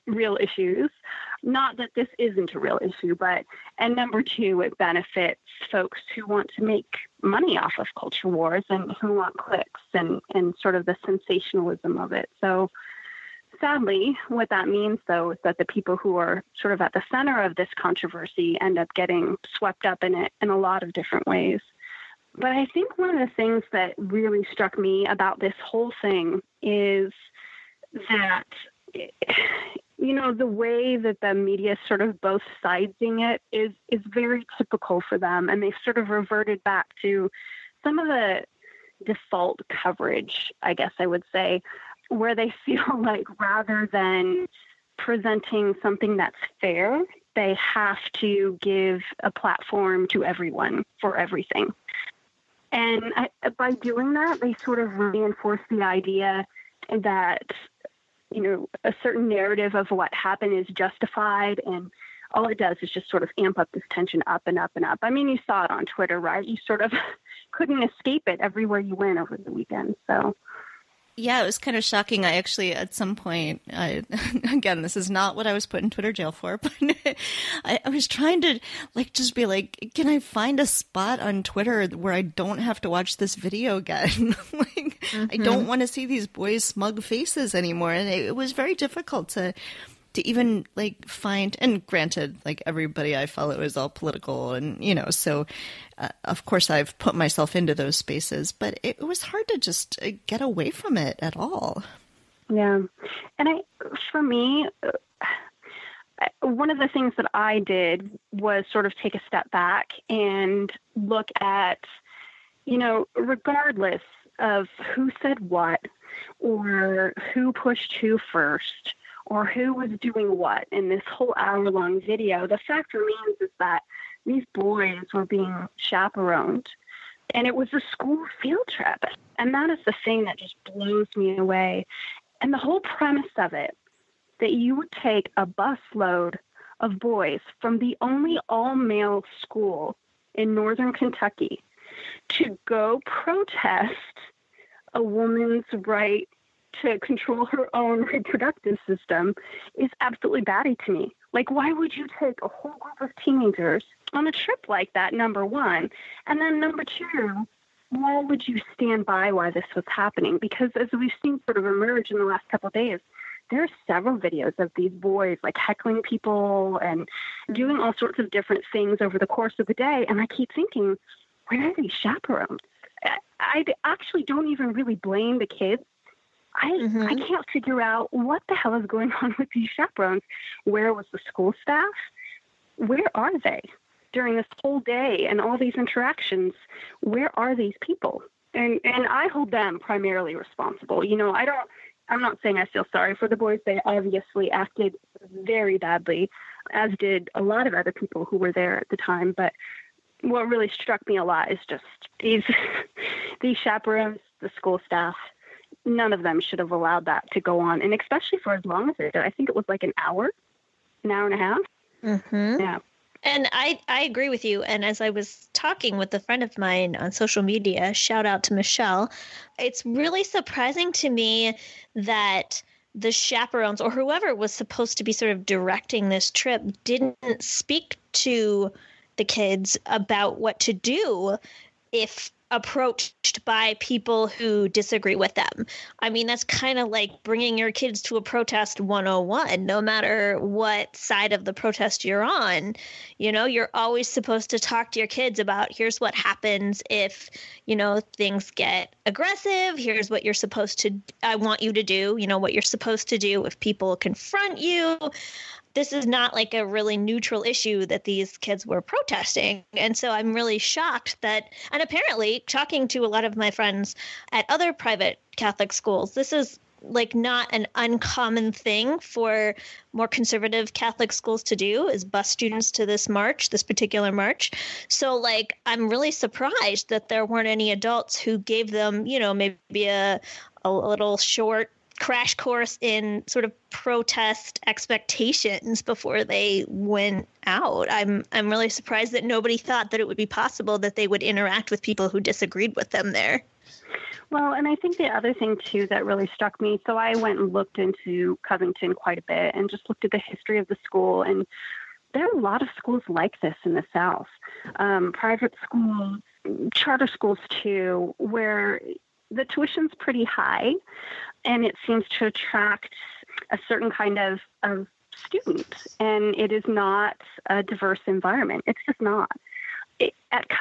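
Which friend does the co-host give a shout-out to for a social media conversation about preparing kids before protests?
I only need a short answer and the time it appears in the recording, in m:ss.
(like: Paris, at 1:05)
Michelle, at 3:38.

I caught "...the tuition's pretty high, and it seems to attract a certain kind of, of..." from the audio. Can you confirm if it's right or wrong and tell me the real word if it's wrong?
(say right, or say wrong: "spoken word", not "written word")
right.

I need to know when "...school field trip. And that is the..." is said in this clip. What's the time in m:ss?
2:07.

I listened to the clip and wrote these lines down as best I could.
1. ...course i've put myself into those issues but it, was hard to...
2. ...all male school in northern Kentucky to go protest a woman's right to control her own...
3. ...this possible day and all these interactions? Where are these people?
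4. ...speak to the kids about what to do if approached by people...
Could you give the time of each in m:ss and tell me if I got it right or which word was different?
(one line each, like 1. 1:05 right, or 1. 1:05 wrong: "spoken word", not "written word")
1. 1:36 wrong: "spaces", not "issues"
2. 2:18 right
3. 3:04 wrong: "whole", not "possible"
4. 3:47 right.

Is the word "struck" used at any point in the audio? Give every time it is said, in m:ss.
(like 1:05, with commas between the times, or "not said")
0:24, 3:20, 4:56.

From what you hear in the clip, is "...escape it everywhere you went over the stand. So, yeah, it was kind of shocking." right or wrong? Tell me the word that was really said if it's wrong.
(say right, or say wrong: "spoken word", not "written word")
wrong: "weekend", not "stand".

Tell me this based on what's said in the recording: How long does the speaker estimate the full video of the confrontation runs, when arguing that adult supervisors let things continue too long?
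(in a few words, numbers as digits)
an hour and a half.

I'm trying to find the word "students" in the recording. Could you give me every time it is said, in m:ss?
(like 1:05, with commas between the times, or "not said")
4:32, 5:15.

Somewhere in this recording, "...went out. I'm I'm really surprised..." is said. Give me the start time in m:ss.
4:46.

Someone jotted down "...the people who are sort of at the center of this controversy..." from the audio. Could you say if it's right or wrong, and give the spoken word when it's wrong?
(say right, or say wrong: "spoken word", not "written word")
right.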